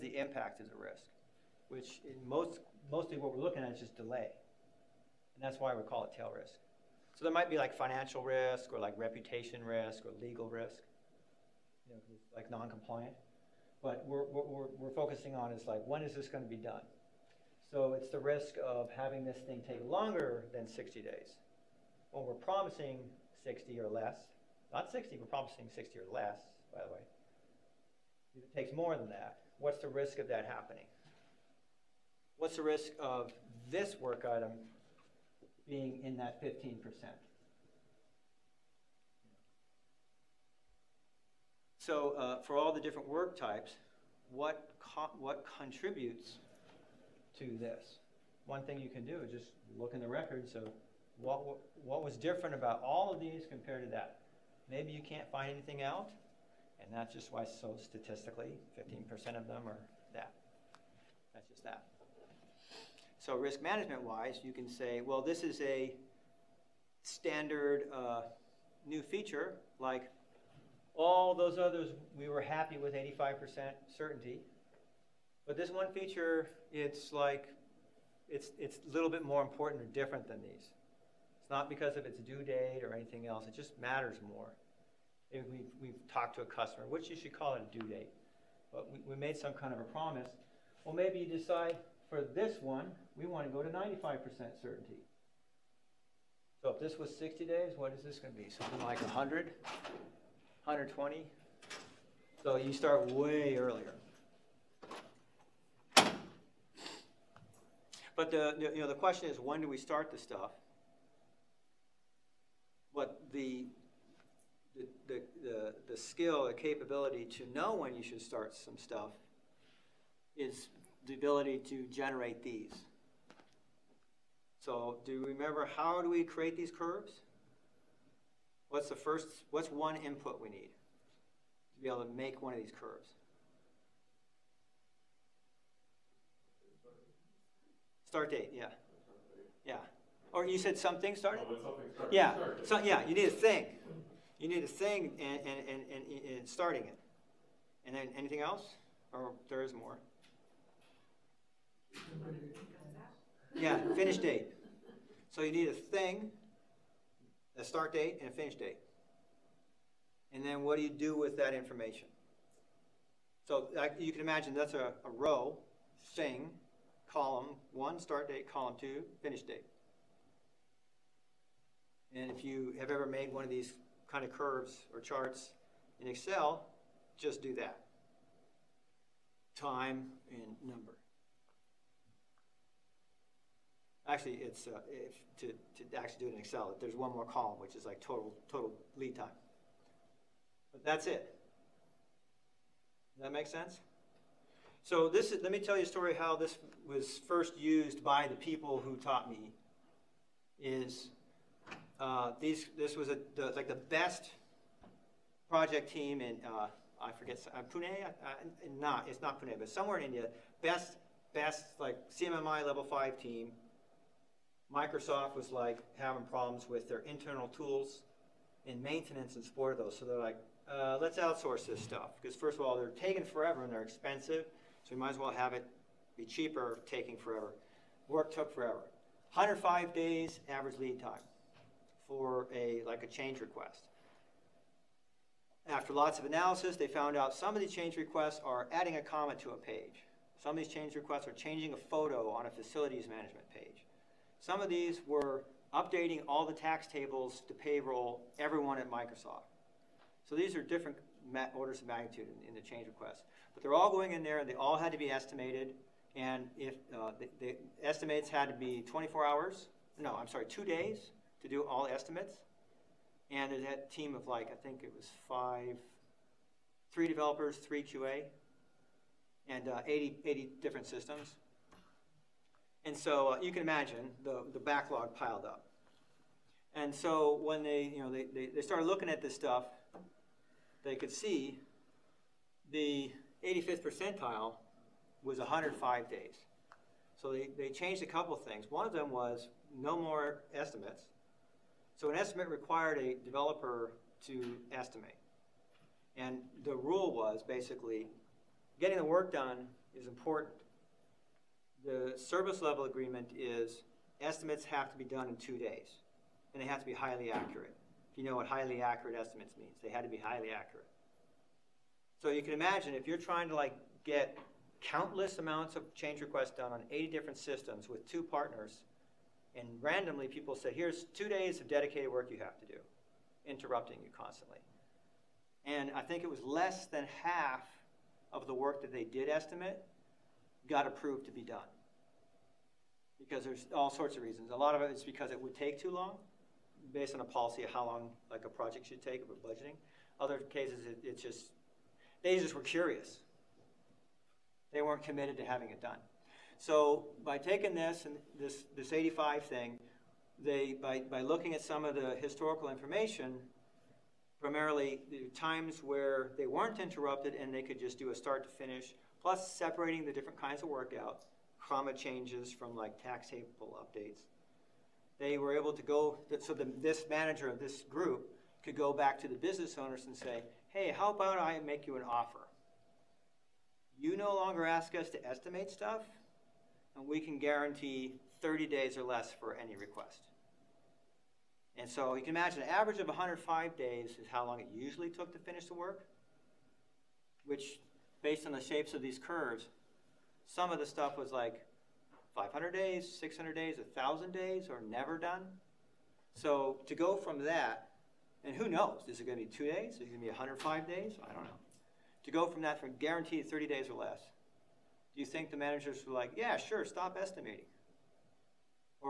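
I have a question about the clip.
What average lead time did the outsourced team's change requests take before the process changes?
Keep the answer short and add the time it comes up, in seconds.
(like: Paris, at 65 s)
105 days, at 229 s.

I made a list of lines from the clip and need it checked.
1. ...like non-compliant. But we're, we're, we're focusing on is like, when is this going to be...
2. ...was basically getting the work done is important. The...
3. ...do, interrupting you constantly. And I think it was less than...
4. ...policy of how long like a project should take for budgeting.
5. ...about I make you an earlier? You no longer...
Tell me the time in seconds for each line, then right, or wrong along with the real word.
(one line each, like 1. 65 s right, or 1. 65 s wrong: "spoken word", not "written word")
1. 12 s right
2. 297 s right
3. 322 s right
4. 337 s right
5. 371 s wrong: "offer", not "earlier".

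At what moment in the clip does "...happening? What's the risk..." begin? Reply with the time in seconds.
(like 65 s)
30 s.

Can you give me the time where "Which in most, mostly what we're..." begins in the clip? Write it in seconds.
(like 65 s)
1 s.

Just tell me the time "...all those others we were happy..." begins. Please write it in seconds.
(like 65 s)
70 s.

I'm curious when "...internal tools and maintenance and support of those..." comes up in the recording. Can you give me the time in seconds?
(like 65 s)
216 s.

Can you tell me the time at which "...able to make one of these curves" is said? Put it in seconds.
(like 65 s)
131 s.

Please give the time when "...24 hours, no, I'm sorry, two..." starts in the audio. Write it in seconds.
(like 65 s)
258 s.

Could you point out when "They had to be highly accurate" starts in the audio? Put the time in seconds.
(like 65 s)
309 s.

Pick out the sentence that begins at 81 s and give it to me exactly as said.
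It's not because of its due date or anything else.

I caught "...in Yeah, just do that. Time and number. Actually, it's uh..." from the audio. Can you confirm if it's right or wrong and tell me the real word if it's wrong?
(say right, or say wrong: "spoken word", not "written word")
wrong: "Excel", not "Yeah".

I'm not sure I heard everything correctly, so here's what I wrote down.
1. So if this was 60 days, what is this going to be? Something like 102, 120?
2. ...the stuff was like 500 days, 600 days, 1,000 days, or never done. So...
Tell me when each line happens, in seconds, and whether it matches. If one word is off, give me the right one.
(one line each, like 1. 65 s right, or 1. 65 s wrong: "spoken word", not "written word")
1. 96 s wrong: "100", not "102"
2. 390 s right.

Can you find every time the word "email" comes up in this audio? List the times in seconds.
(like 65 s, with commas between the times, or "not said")
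not said.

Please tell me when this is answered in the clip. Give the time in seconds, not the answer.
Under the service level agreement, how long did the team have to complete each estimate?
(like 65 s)
305 s.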